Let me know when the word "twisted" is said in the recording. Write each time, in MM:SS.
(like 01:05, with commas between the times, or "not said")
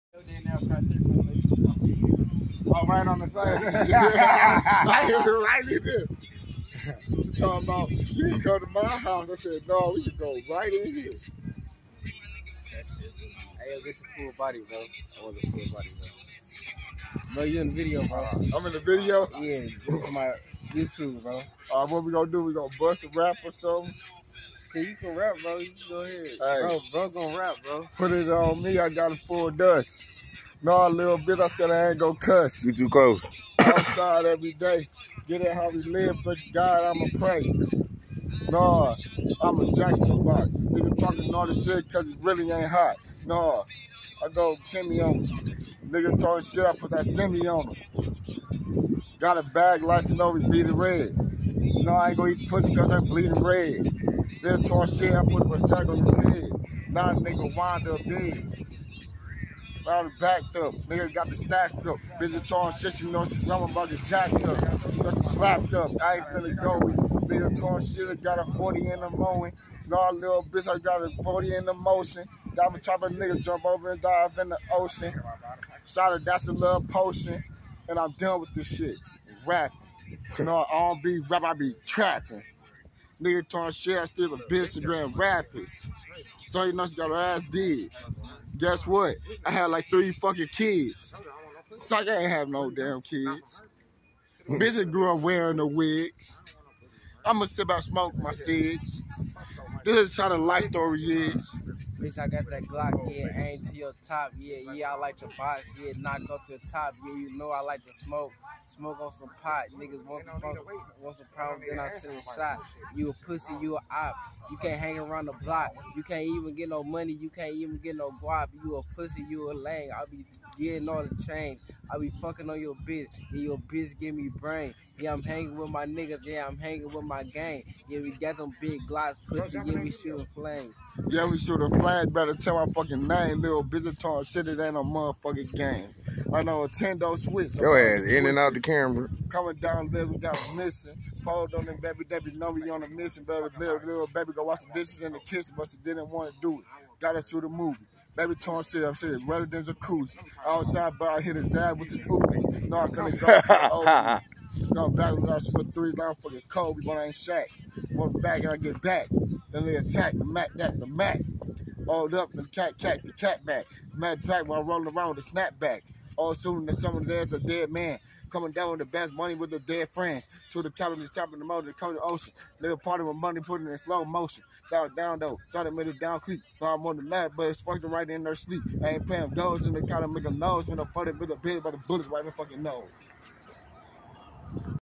not said.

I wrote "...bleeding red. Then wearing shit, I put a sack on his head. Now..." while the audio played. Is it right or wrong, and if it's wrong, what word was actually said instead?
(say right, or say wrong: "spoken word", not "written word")
wrong: "talking", not "wearing".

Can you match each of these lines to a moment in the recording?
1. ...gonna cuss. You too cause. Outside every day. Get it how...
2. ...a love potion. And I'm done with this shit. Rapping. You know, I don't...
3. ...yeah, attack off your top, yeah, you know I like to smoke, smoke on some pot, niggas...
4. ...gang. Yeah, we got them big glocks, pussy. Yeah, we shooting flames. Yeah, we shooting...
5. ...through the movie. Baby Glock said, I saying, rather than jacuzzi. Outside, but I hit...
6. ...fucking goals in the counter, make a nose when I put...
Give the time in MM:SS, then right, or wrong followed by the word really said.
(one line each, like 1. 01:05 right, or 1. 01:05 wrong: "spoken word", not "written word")
1. 00:31 wrong: "close", not "cause"
2. 01:16 right
3. 01:45 wrong: "knock", not "attack"
4. 02:07 right
5. 02:27 wrong: "Torn", not "Glock"
6. 02:59 wrong: "paying", not "fucking".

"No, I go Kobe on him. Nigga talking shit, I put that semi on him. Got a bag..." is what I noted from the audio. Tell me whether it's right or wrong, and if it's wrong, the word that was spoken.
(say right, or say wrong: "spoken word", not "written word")
wrong: "Kimmy", not "Kobe".